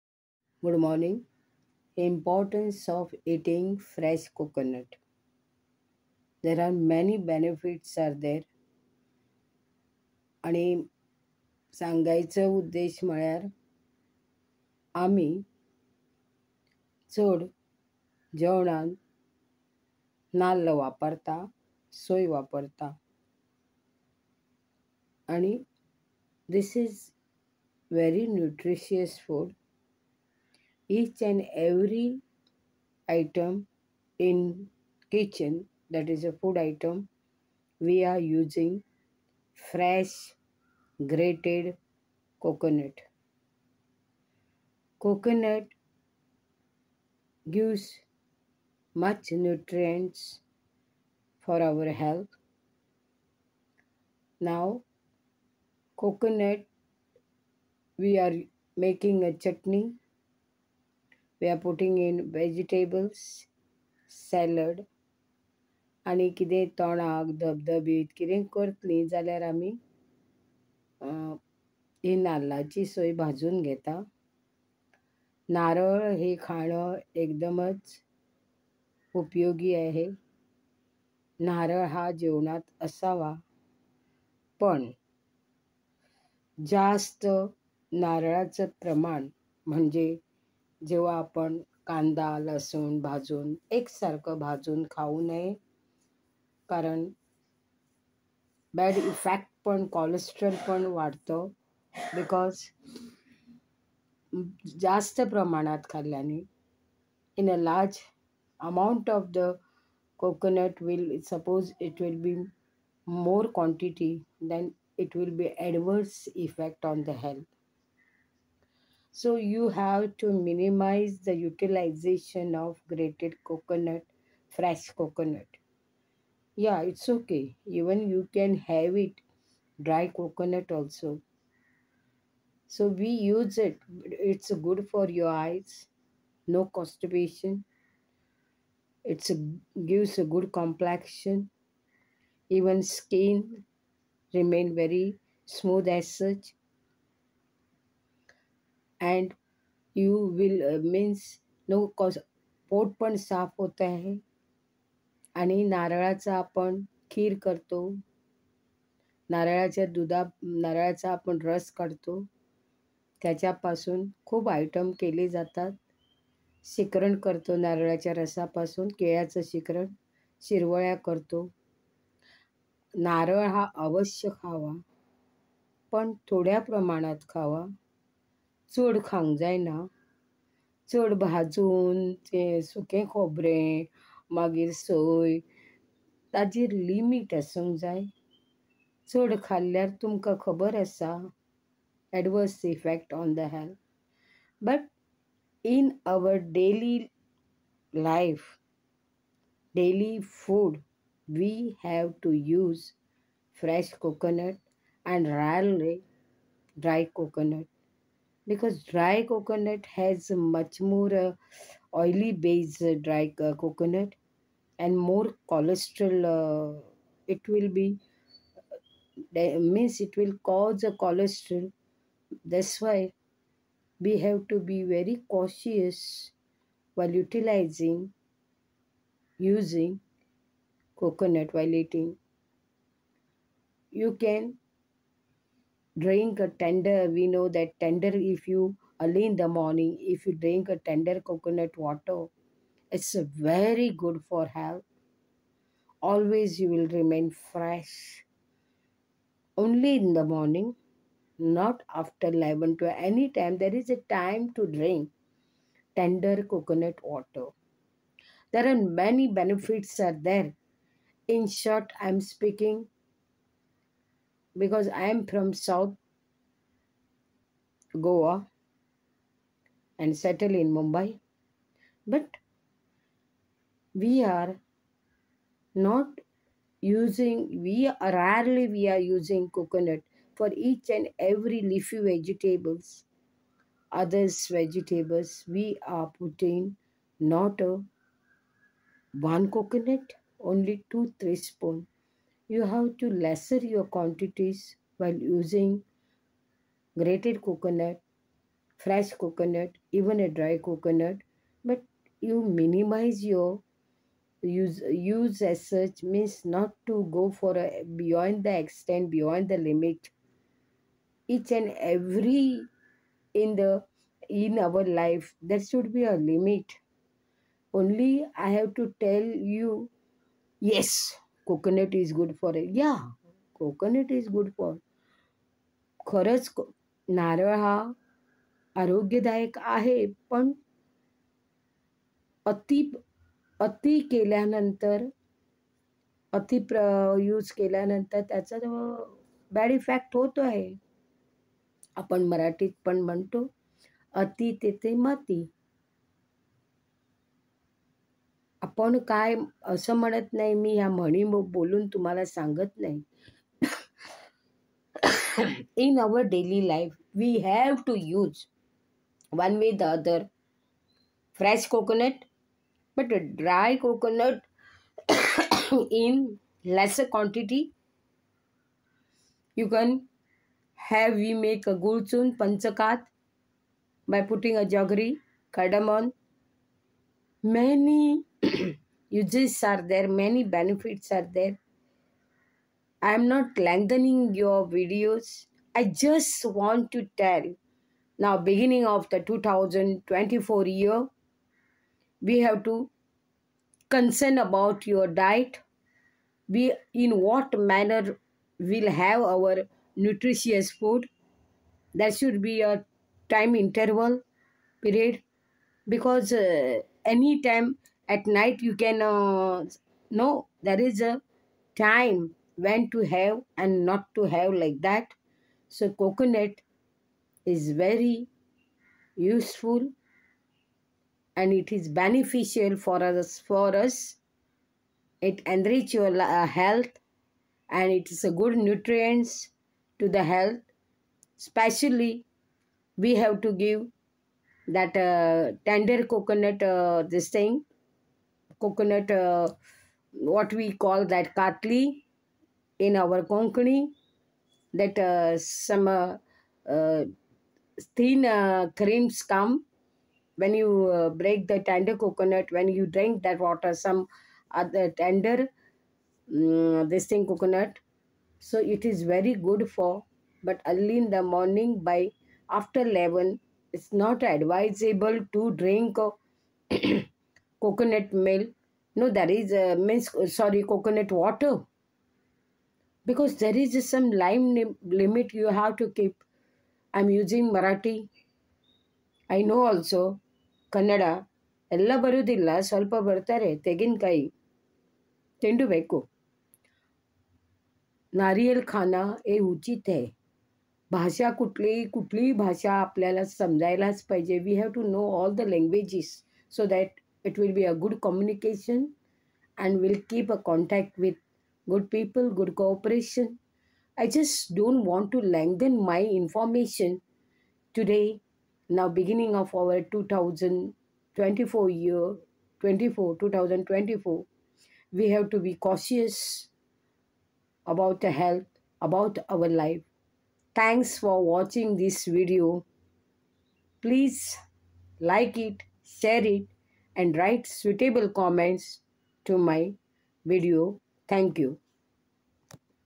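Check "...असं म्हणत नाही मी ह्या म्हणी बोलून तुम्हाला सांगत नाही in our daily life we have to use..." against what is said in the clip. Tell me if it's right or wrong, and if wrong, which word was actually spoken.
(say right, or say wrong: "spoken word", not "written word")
right.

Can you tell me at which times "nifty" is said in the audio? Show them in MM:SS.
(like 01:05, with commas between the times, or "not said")
not said.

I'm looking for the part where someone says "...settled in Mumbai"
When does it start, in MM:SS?
04:30.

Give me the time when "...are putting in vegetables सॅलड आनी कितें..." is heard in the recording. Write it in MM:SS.
01:01.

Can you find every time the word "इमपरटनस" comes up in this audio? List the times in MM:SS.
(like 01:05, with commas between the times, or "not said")
00:02.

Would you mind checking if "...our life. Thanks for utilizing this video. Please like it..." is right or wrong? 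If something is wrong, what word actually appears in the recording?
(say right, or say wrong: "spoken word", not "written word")
wrong: "watching", not "utilizing".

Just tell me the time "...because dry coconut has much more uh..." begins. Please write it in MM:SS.
03:28.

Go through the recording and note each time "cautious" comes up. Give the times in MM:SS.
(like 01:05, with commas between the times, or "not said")
03:45, 08:35.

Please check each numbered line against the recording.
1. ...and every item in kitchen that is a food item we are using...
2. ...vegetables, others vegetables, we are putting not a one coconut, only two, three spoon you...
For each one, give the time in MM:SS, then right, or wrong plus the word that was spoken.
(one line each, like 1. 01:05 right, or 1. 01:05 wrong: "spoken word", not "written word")
1. 00:31 right
2. 04:41 right.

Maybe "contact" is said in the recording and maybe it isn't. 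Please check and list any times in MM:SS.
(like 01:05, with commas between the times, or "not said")
08:20.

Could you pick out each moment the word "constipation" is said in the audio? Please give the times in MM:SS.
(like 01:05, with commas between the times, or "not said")
02:16.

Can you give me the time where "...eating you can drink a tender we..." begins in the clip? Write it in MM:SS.
03:51.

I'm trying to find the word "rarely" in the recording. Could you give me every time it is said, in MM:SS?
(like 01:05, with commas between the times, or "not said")
04:38.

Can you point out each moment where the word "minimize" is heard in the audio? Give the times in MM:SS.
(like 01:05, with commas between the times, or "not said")
02:00, 05:02.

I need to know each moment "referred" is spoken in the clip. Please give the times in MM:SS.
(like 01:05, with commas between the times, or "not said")
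not said.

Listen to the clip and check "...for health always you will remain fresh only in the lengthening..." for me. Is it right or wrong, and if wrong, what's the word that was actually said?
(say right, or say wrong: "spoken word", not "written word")
wrong: "morning", not "lengthening".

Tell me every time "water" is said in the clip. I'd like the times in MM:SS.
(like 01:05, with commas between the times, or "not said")
04:01, 04:17, 07:33, 07:51.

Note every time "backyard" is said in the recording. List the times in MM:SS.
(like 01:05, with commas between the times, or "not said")
not said.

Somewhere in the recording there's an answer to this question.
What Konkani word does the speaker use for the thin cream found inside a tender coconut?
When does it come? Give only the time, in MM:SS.
07:21.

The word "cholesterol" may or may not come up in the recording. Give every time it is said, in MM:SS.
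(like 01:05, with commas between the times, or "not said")
03:35, 03:40.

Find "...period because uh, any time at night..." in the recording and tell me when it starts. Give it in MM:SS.
06:44.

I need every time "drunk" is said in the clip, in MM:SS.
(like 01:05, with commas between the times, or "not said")
not said.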